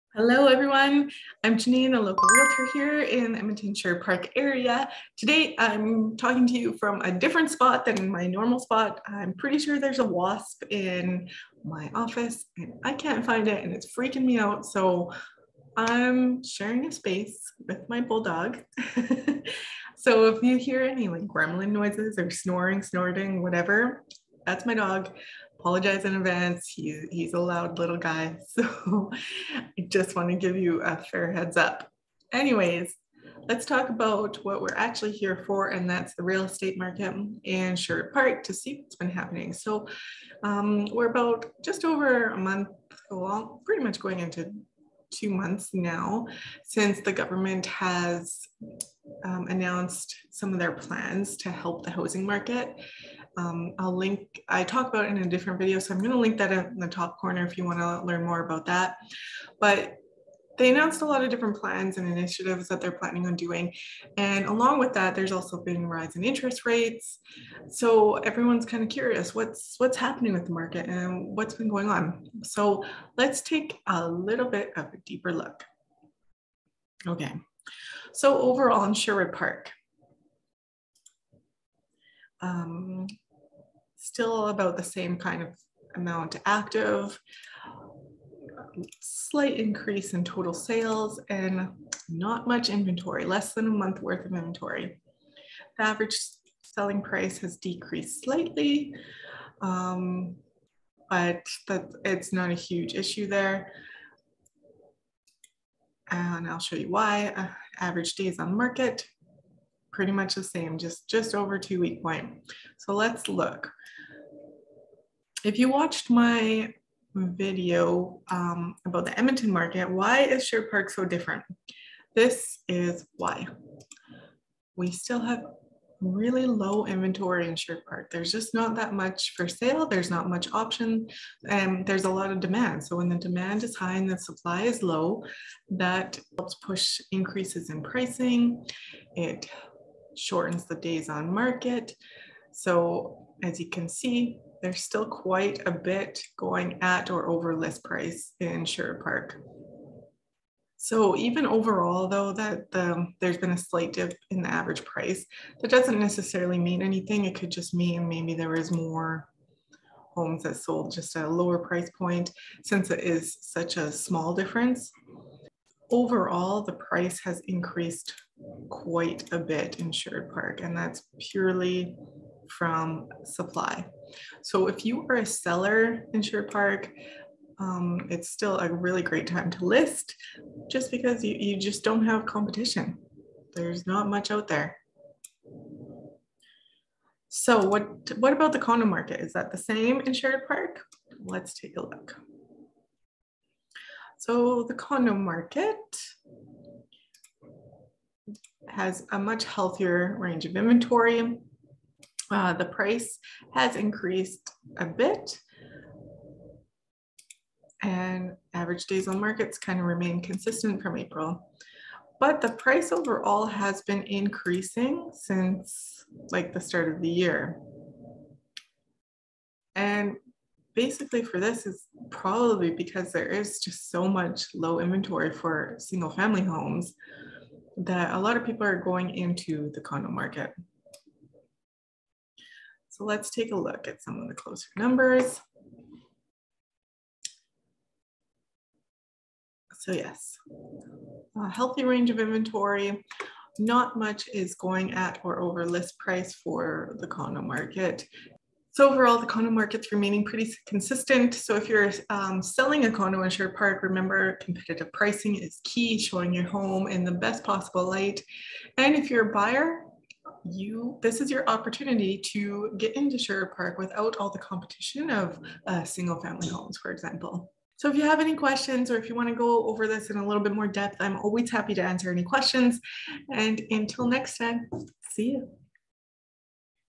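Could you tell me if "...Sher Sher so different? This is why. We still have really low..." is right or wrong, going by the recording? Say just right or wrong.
wrong.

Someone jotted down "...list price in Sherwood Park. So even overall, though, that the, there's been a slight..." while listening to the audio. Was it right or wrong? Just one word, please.
right.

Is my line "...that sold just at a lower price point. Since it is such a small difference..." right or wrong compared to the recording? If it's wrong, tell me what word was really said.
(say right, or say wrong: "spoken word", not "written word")
right.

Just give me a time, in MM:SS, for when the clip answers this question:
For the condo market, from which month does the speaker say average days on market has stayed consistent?
03:30.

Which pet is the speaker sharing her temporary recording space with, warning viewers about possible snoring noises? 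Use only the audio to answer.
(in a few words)
Bulldog.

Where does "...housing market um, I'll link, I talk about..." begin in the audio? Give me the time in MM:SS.
00:51.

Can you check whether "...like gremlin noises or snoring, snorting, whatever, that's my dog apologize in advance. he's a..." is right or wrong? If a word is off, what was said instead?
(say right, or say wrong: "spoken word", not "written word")
right.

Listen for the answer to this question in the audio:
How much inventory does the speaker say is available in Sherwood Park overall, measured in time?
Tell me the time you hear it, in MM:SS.
01:33.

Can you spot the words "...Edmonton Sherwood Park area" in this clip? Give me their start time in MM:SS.
00:03.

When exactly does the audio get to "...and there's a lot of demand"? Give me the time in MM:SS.
02:11.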